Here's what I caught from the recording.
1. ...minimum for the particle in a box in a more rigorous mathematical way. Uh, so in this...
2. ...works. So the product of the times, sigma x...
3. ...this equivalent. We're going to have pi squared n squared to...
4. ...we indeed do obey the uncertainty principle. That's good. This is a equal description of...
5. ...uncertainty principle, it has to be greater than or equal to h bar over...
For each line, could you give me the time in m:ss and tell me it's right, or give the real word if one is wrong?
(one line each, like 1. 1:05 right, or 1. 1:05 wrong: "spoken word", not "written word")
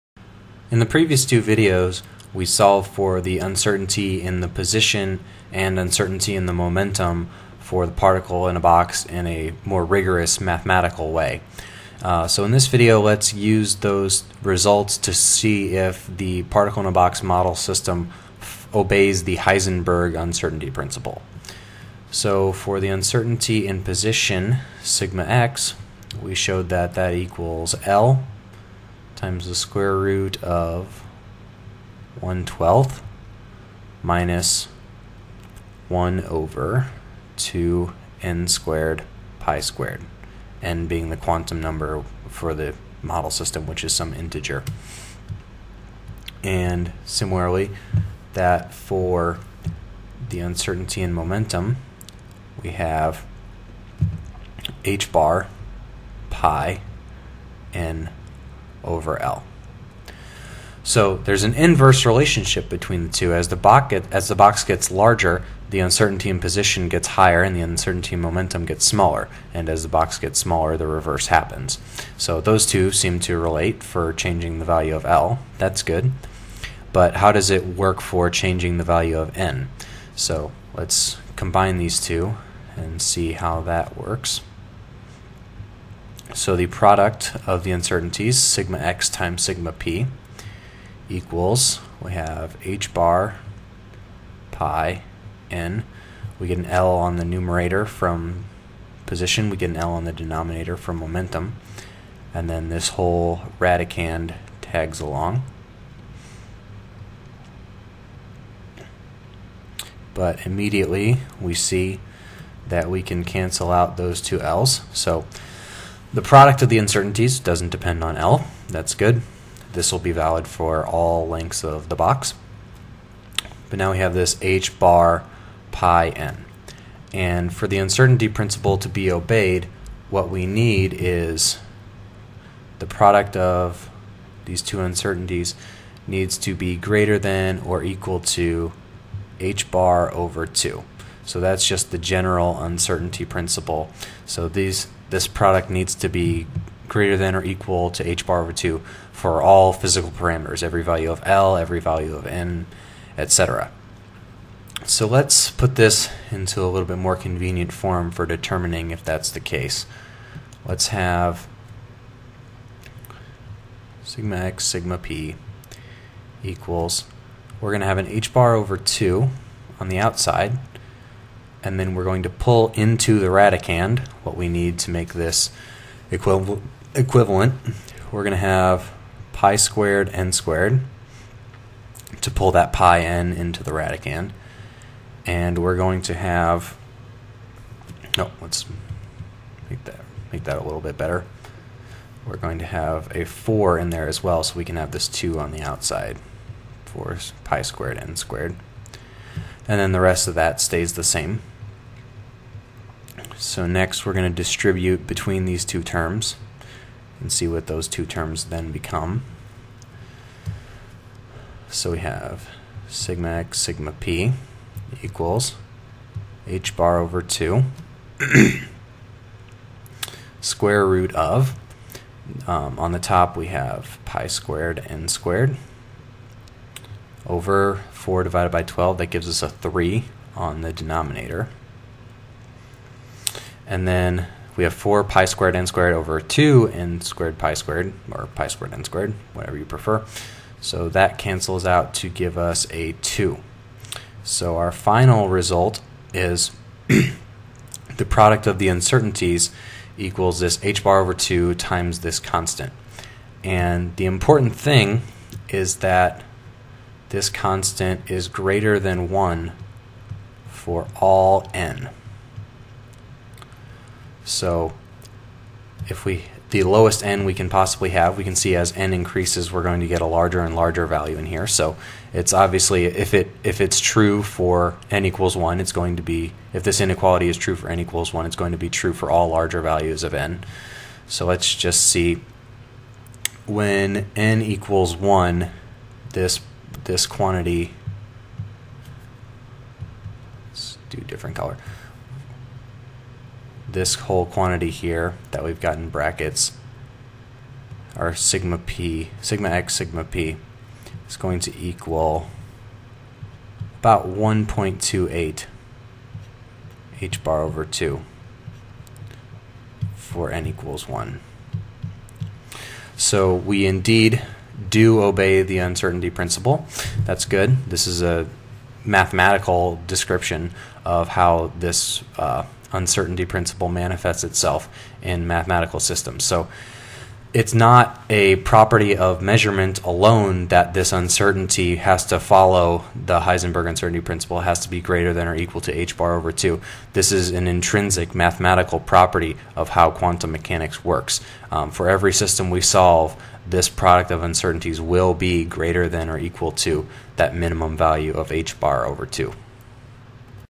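1. 0:06 wrong: "momentum", not "minimum"
2. 1:23 wrong: "uncertainties", not "times"
3. 2:55 right
4. 5:13 wrong: "mathematical", not "equal"
5. 5:33 right.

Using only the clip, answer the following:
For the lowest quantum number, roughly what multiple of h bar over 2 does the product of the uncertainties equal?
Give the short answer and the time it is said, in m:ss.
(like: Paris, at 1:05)
1.28, at 5:04.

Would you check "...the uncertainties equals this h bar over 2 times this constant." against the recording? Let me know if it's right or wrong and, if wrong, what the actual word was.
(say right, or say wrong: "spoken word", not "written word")
right.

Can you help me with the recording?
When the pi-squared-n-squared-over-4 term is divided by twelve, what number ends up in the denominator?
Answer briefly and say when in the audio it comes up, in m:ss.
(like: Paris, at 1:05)
3, at 3:49.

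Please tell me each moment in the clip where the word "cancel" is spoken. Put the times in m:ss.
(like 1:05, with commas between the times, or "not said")
1:53, 4:01.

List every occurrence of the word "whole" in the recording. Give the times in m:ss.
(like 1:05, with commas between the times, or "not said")
1:42, 4:53.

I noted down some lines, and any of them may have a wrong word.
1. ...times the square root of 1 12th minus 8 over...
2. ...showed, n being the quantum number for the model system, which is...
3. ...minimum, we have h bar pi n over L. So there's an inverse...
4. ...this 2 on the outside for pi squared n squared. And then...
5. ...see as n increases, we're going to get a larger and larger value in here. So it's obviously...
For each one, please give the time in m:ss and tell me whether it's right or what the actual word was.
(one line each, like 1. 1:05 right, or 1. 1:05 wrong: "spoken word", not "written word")
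1. 0:29 wrong: "1", not "8"
2. 0:39 wrong: "squared", not "showed"
3. 0:51 wrong: "momentum", not "minimum"
4. 3:14 right
5. 4:28 right.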